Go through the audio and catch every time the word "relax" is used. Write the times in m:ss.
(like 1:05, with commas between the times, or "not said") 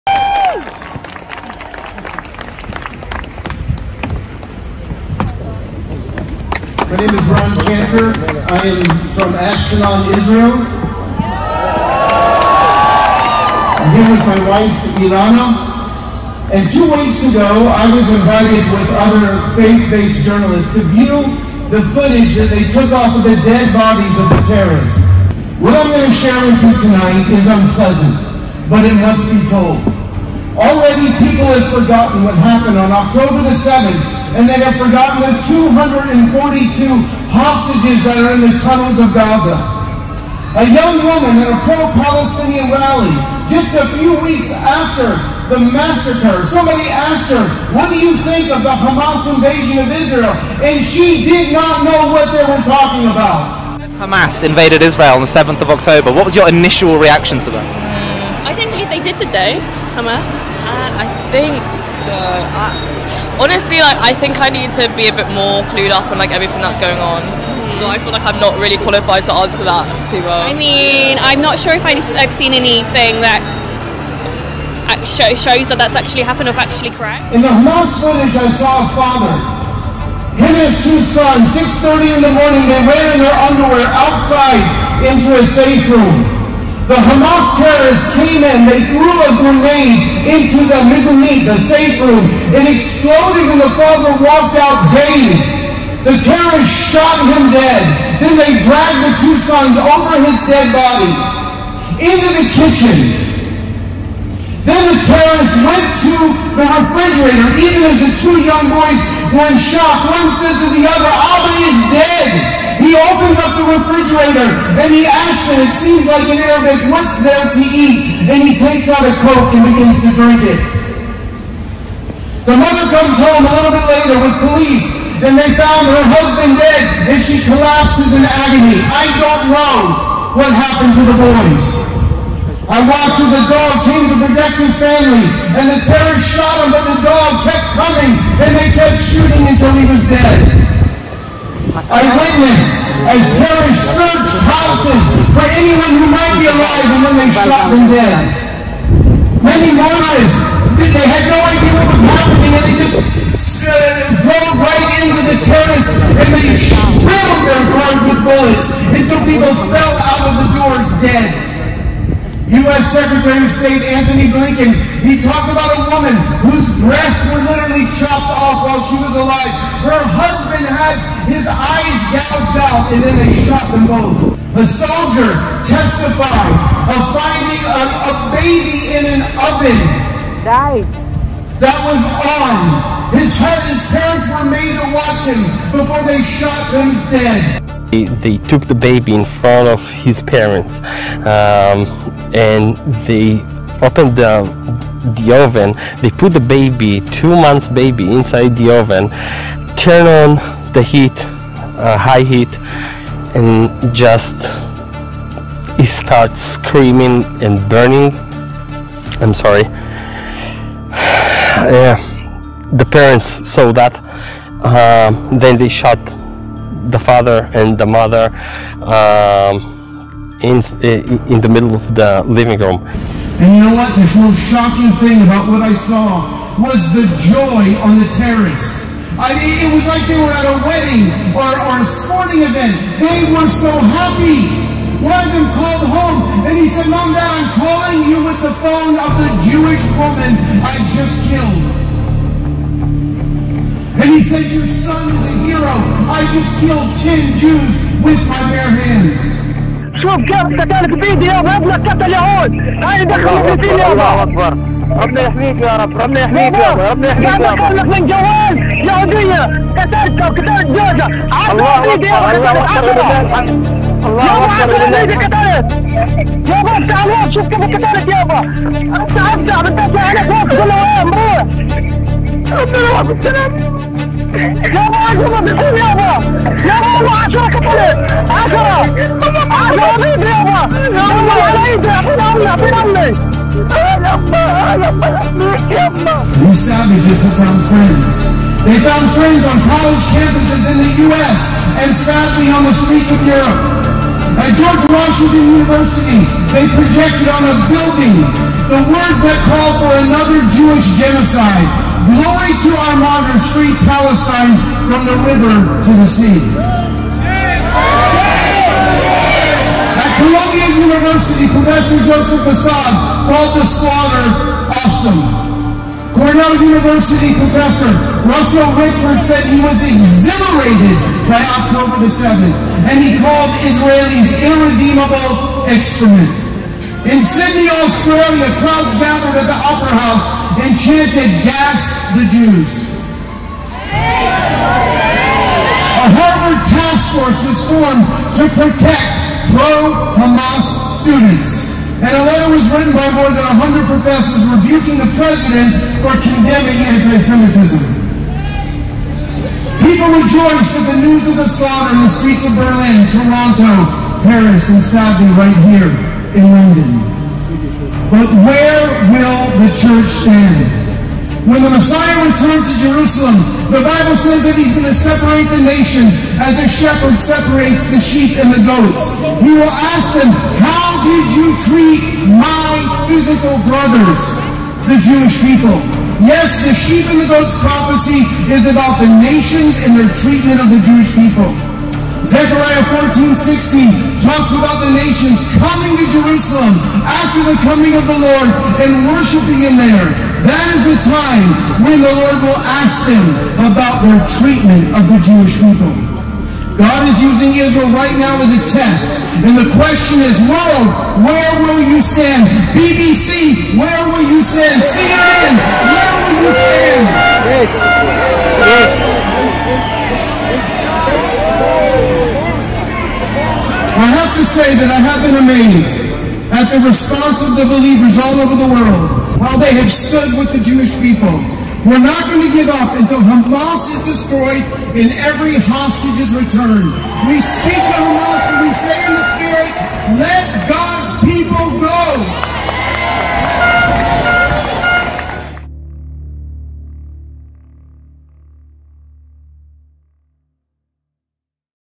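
not said.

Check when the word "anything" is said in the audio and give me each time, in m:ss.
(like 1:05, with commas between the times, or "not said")
1:12.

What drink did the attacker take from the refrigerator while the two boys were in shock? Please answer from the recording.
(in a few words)
Coke.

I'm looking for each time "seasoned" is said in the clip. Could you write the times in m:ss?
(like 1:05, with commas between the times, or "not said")
not said.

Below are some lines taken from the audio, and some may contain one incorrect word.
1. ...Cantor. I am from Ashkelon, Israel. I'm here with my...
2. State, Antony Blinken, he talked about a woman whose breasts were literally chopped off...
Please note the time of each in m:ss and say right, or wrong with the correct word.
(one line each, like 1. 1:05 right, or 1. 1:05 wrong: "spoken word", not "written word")
1. 0:07 right
2. 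2:43 right.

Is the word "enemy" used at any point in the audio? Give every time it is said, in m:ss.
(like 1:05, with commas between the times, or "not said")
not said.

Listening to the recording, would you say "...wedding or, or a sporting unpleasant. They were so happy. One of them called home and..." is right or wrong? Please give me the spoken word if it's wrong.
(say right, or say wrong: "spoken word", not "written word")
wrong: "event", not "unpleasant".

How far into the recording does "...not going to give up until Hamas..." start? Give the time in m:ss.
7:02.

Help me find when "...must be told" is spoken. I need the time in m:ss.
0:28.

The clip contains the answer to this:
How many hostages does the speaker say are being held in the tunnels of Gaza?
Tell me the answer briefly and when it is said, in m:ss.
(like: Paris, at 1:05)
242, at 0:35.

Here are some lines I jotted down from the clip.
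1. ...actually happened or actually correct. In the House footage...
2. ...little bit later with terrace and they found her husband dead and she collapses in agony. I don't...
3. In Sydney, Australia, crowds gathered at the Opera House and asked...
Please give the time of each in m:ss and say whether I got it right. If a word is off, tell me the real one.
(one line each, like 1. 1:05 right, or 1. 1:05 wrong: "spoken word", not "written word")
1. 1:15 wrong: "Hamas", not "House"
2. 2:03 wrong: "police", not "terrace"
3. 5:27 wrong: "chanted", not "asked".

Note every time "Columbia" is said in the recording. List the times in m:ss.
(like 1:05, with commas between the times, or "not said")
5:10.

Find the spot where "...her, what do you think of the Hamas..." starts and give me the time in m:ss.
0:47.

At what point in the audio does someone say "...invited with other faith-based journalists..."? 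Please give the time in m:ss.
0:18.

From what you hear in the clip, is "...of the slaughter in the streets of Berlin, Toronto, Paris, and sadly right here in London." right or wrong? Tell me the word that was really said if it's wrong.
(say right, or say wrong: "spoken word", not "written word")
right.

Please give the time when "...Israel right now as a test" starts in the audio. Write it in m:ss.
6:37.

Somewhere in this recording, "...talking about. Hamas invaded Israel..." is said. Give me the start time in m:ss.
0:52.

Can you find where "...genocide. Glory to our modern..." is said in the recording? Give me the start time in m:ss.
5:00.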